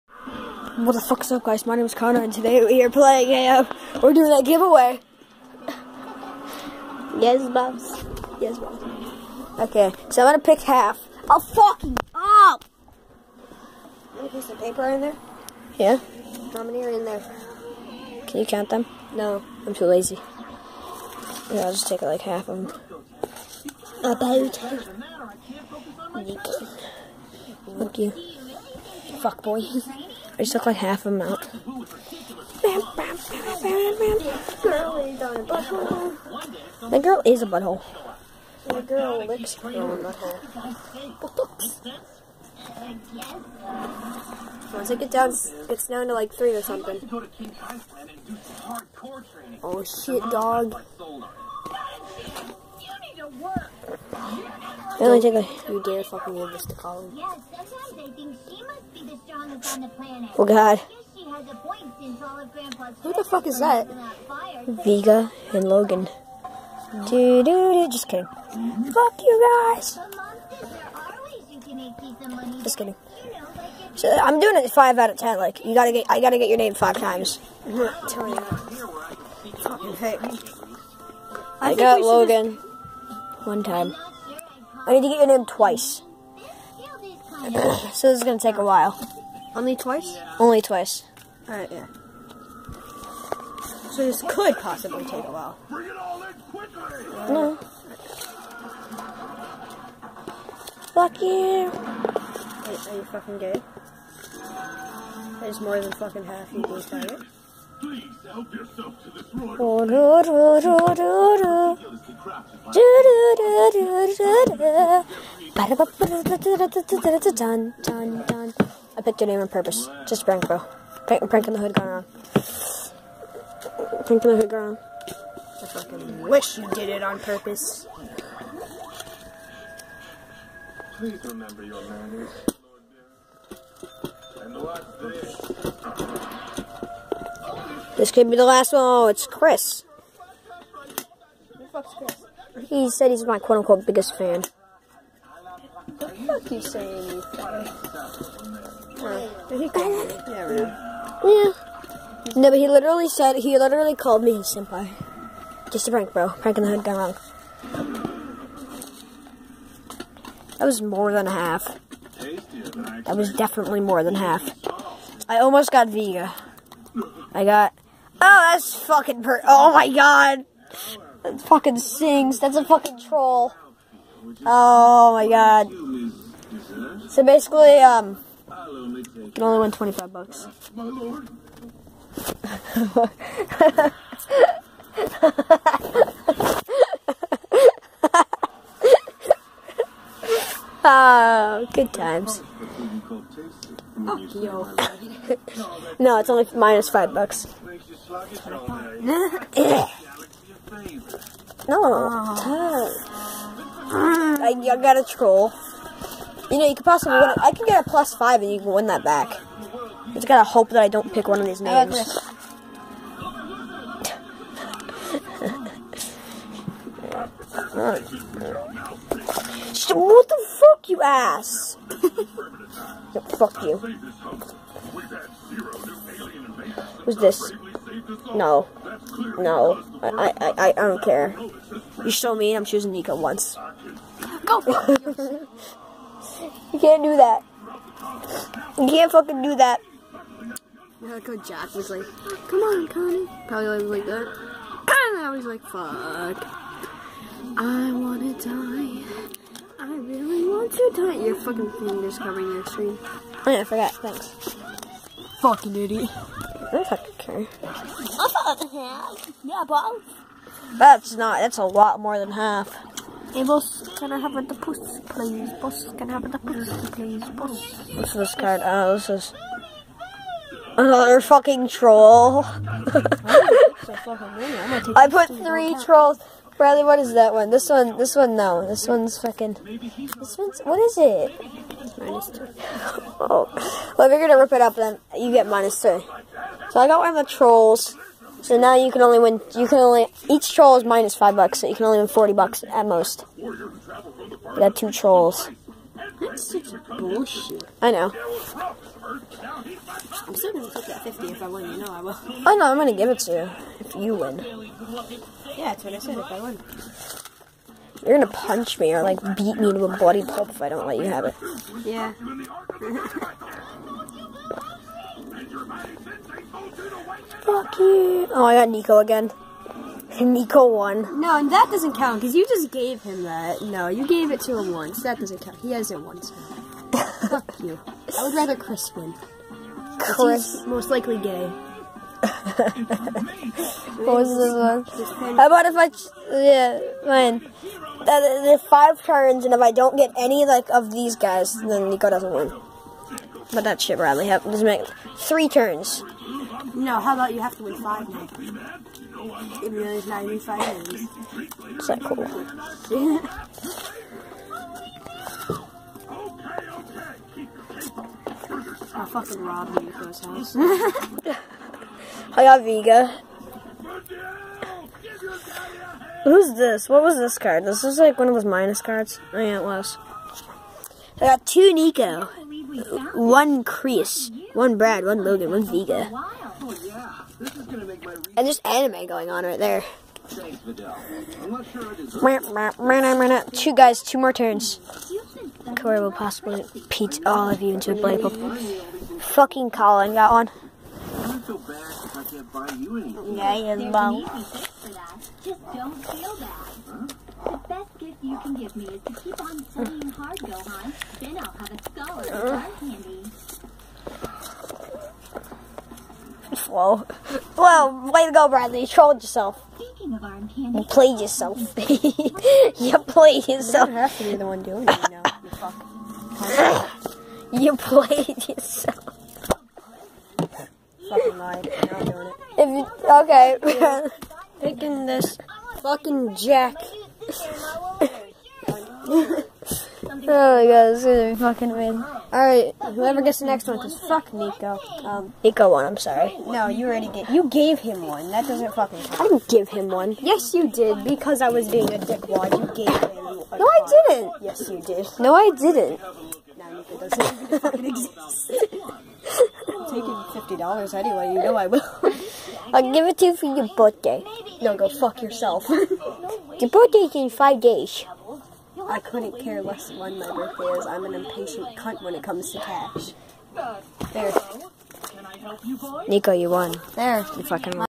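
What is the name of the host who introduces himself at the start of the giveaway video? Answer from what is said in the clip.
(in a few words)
Connor.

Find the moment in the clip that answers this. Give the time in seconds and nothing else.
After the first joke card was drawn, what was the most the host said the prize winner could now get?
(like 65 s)
179 s.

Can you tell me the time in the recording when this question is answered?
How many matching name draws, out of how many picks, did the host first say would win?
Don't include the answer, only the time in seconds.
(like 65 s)
74 s.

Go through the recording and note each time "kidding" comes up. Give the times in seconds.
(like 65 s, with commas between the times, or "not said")
68 s, 72 s.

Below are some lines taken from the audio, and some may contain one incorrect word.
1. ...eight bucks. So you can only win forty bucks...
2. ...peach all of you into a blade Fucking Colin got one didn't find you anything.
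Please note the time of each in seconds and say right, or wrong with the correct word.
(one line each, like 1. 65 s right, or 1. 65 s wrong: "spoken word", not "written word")
1. 291 s wrong: "five", not "eight"
2. 386 s right.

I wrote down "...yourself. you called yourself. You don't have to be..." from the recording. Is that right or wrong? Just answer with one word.
wrong.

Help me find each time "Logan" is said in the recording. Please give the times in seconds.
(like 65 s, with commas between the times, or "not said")
65 s, 82 s, 375 s.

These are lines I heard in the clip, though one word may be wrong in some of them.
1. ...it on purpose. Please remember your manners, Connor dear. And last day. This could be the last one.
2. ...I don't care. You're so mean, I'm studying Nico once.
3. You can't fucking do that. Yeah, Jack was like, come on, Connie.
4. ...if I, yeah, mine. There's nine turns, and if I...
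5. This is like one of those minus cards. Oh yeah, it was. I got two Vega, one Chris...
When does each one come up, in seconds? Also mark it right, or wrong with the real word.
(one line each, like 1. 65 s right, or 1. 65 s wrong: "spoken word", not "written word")
1. 126 s wrong: "Lord", not "Connor"
2. 230 s wrong: "choosing", not "studying"
3. 238 s right
4. 335 s wrong: "five", not "nine"
5. 367 s wrong: "Nico", not "Vega".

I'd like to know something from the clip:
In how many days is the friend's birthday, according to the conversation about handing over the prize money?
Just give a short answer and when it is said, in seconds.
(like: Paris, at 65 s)
5 days, at 457 s.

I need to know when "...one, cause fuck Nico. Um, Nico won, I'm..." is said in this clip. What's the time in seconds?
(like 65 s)
433 s.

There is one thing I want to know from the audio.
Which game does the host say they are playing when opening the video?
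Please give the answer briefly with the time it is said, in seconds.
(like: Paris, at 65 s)
AO, at 3 s.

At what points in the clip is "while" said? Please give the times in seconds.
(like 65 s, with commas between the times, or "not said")
88 s, 95 s.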